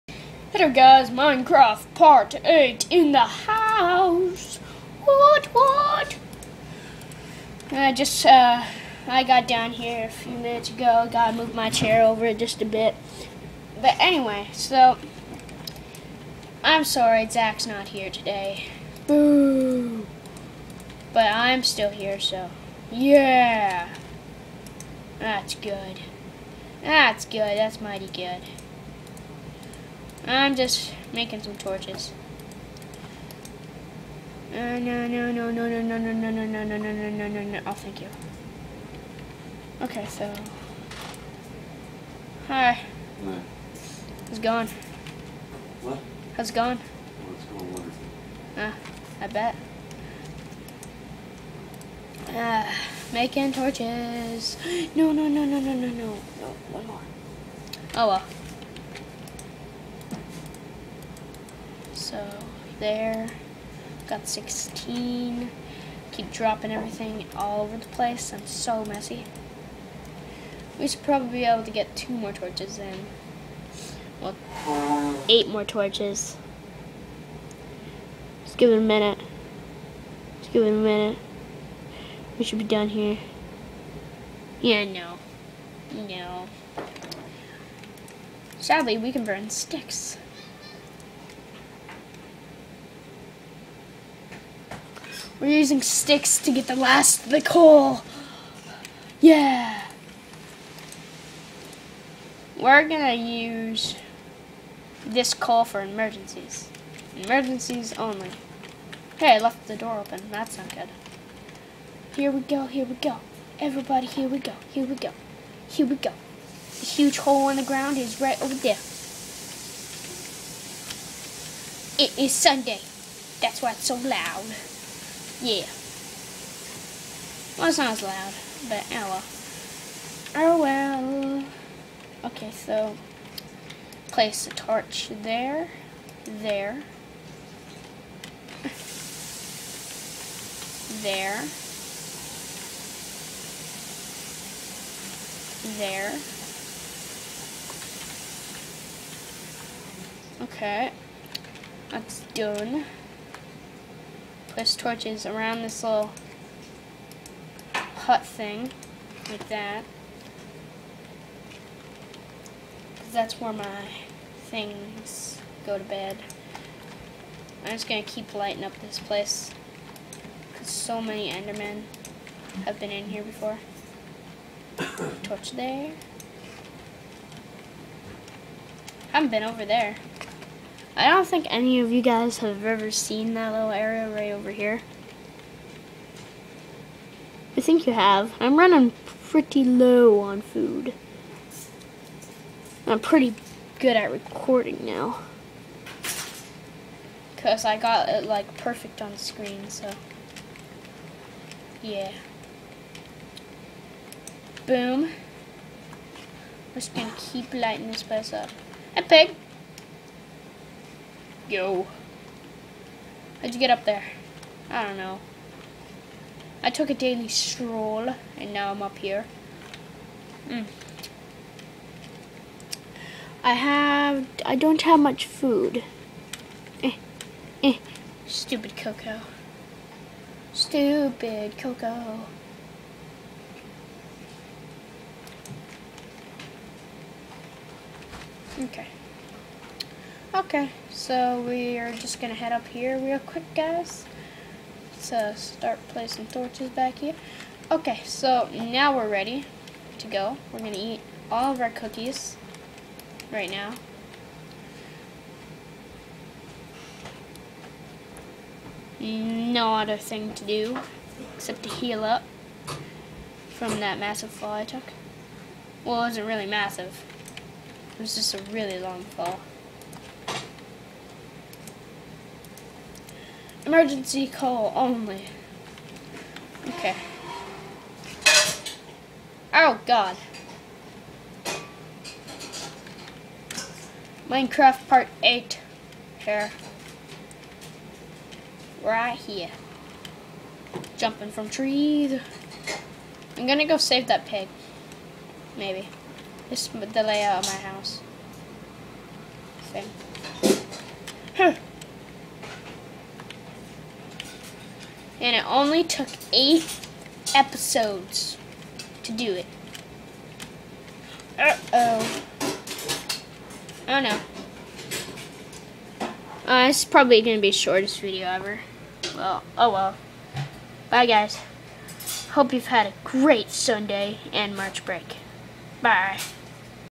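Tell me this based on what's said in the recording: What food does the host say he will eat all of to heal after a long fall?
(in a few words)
Cookies.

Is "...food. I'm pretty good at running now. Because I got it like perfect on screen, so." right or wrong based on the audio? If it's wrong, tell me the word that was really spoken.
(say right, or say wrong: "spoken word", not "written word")
wrong: "recording", not "running".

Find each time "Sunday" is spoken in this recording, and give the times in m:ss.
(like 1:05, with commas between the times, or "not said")
2:02, 5:23.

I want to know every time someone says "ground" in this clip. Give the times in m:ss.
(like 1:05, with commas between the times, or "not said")
1:57.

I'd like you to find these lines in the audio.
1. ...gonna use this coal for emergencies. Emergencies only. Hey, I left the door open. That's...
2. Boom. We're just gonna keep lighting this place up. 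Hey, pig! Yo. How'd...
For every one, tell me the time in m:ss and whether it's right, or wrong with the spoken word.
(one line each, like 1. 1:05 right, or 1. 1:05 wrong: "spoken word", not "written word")
1. 1:42 right
2. 3:24 right.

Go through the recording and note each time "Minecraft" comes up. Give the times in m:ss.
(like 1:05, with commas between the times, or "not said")
0:01, 4:44.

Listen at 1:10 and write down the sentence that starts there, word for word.
We should probably be able to get two more torches in.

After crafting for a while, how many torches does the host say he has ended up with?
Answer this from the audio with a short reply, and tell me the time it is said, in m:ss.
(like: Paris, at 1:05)
16, at 1:04.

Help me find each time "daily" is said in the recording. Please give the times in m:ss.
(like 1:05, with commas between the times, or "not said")
3:36.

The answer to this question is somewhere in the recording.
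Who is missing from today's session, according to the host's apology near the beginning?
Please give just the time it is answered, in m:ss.
0:17.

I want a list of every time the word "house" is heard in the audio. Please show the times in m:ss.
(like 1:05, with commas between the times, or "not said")
0:03, 4:57.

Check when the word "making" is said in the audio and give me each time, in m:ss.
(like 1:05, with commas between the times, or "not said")
0:31, 0:53.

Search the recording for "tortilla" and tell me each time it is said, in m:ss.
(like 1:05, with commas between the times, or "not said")
not said.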